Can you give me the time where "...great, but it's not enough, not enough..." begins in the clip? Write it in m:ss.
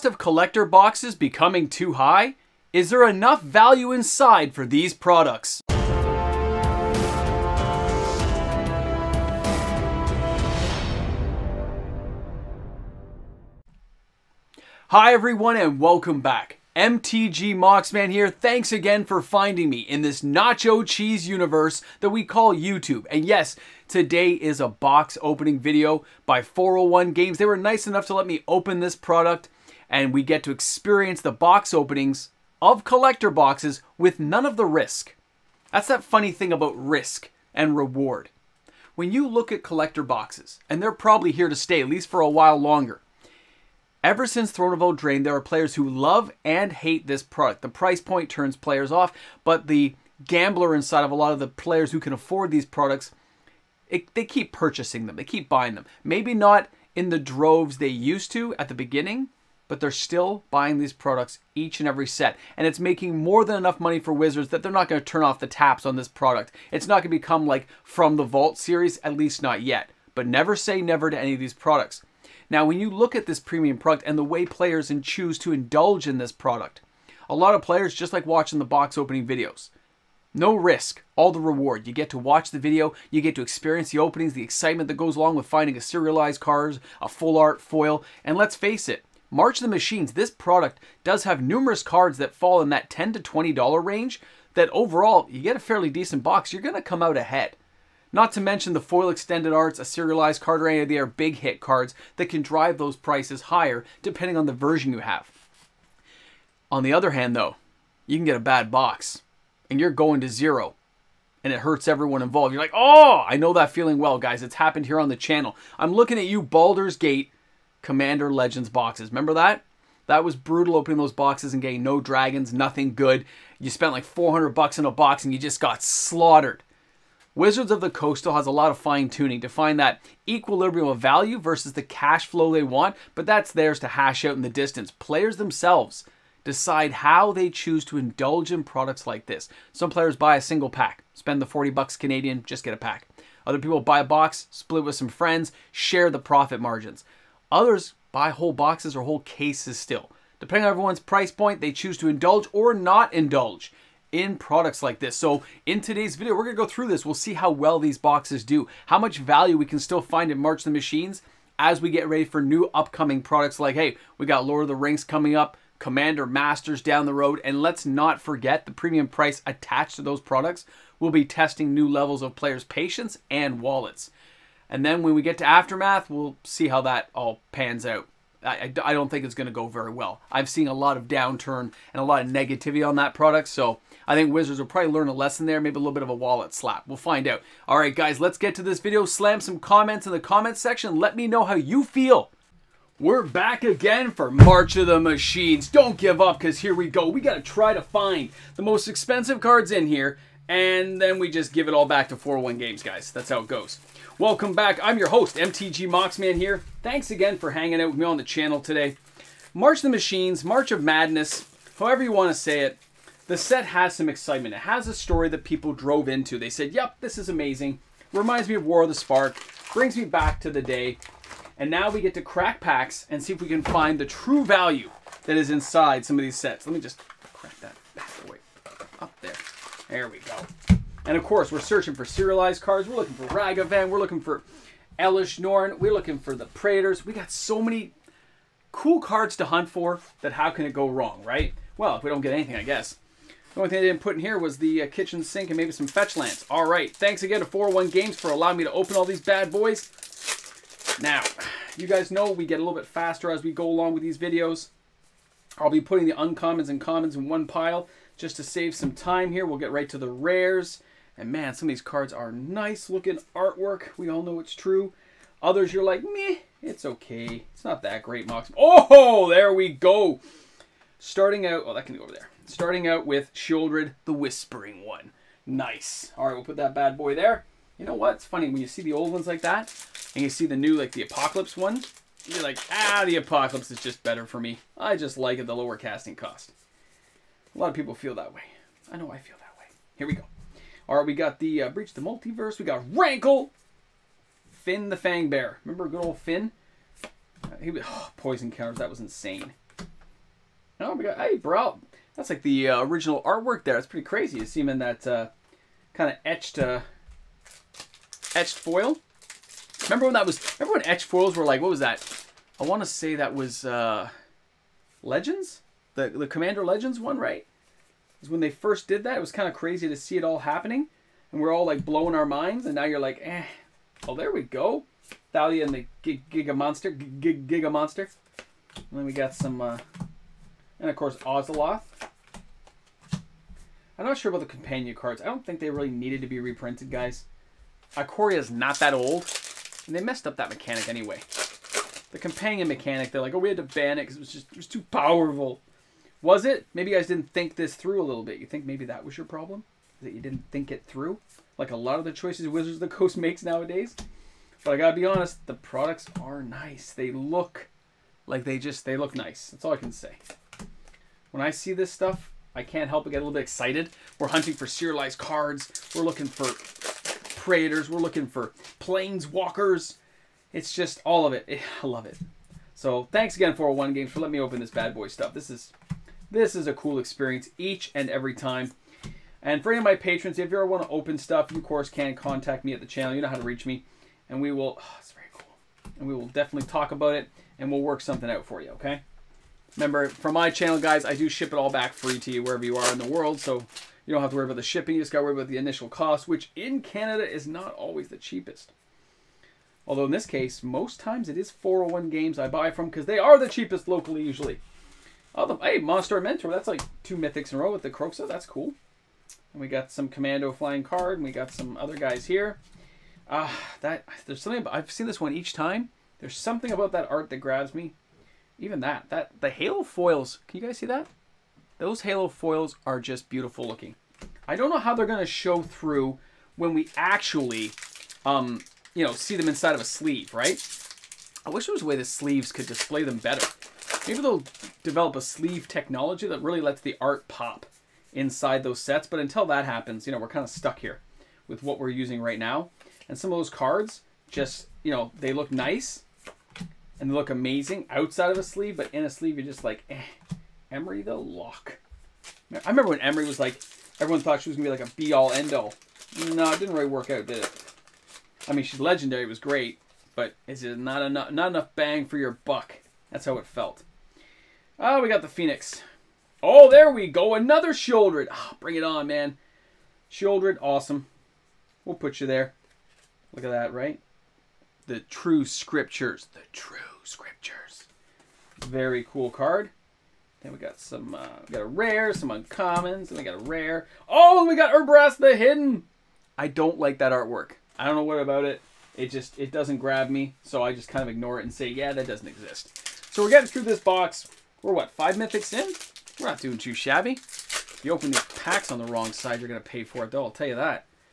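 7:39.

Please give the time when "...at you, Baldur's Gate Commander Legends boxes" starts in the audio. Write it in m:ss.
1:56.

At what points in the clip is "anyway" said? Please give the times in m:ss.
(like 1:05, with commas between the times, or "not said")
5:40.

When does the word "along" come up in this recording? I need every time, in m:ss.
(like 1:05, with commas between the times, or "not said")
1:25, 4:13.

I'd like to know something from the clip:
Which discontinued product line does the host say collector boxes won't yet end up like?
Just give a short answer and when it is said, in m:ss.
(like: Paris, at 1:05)
From the Vault, at 1:07.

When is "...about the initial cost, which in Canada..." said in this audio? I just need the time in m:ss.
6:35.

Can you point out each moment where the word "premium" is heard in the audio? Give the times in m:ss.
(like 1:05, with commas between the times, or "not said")
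1:13, 2:48.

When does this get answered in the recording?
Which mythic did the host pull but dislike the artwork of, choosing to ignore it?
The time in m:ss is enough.
8:04.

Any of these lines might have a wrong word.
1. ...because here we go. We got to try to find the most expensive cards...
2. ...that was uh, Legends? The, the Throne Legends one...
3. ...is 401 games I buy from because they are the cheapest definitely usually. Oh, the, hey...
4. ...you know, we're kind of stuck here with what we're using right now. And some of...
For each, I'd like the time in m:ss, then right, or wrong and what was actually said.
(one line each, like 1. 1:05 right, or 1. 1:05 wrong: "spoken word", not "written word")
1. 3:16 right
2. 5:13 wrong: "Commander", not "Throne"
3. 6:41 wrong: "locally", not "definitely"
4. 7:20 right.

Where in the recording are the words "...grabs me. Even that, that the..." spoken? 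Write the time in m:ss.
6:57.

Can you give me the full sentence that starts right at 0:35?
That's that funny thing about risk and reward.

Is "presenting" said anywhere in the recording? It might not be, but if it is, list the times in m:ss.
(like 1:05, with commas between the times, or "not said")
not said.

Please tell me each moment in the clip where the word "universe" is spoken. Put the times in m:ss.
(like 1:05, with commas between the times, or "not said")
0:21.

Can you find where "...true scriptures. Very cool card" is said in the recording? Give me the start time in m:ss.
7:56.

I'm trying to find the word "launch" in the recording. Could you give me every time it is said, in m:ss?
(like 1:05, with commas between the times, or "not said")
not said.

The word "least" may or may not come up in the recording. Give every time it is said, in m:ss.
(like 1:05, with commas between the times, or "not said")
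0:41, 1:09.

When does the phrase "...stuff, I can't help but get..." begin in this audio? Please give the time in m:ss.
6:01.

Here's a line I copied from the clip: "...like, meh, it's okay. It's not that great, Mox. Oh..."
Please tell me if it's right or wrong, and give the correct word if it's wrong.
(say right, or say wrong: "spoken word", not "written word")
right.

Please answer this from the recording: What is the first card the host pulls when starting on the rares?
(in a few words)
Sheoldred, the Whispering One.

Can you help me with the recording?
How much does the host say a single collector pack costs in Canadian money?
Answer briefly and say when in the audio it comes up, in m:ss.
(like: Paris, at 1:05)
$40, at 2:21.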